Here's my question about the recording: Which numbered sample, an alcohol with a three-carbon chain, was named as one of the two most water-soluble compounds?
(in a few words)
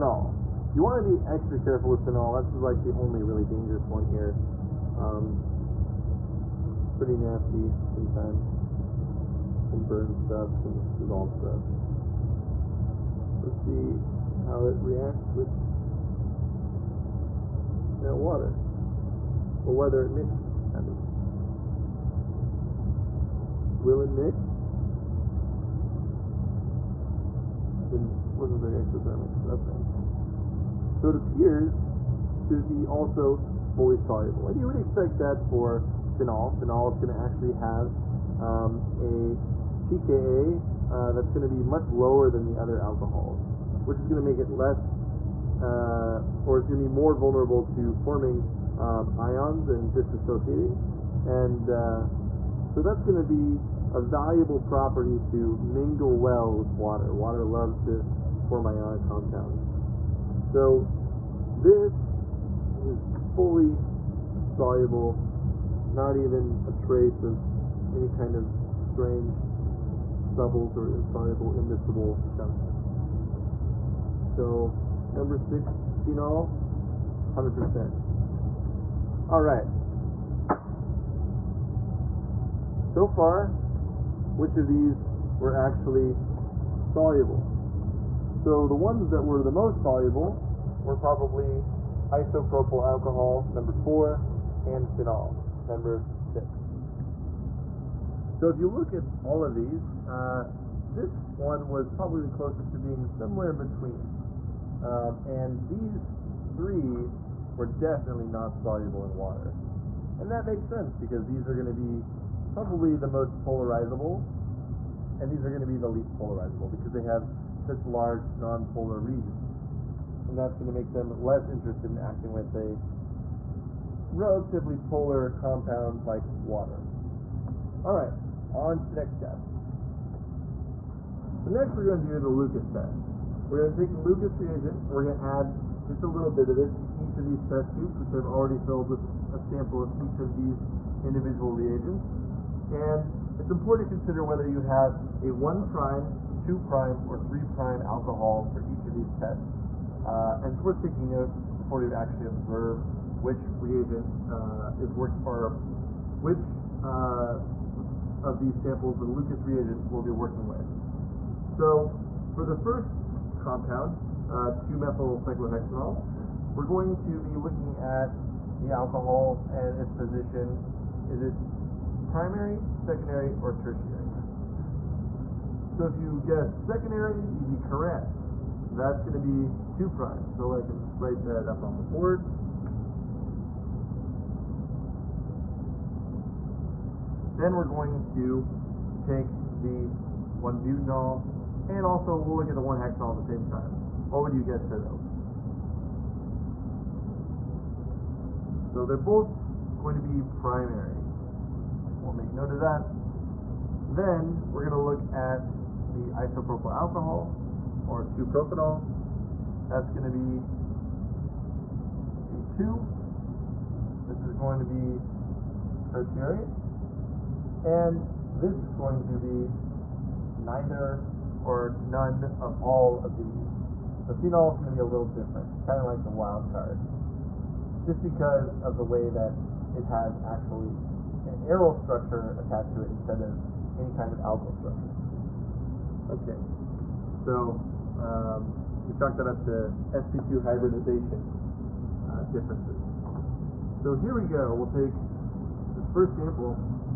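Number four.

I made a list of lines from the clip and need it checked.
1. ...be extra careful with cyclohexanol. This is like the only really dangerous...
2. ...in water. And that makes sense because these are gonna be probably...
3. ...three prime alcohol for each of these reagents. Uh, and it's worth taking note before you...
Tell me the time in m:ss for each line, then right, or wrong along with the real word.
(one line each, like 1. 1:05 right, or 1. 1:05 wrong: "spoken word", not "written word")
1. 0:01 wrong: "phenol", not "cyclohexanol"
2. 1:49 right
3. 2:27 wrong: "tests", not "reagents".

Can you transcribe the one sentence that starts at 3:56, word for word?
Okay, so um, we chalk that up to sp2 hybridization uh, differences.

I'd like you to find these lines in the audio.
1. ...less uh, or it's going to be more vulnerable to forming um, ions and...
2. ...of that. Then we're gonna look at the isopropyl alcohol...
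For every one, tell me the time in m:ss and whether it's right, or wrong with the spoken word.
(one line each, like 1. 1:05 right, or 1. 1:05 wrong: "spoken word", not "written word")
1. 0:44 right
2. 3:22 right.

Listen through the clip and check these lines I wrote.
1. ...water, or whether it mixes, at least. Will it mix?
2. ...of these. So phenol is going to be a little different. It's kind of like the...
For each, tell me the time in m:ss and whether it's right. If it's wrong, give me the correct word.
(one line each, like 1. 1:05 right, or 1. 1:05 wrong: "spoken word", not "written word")
1. 0:18 right
2. 3:43 right.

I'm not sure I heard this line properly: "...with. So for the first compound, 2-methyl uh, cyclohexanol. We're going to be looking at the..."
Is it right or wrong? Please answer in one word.
right.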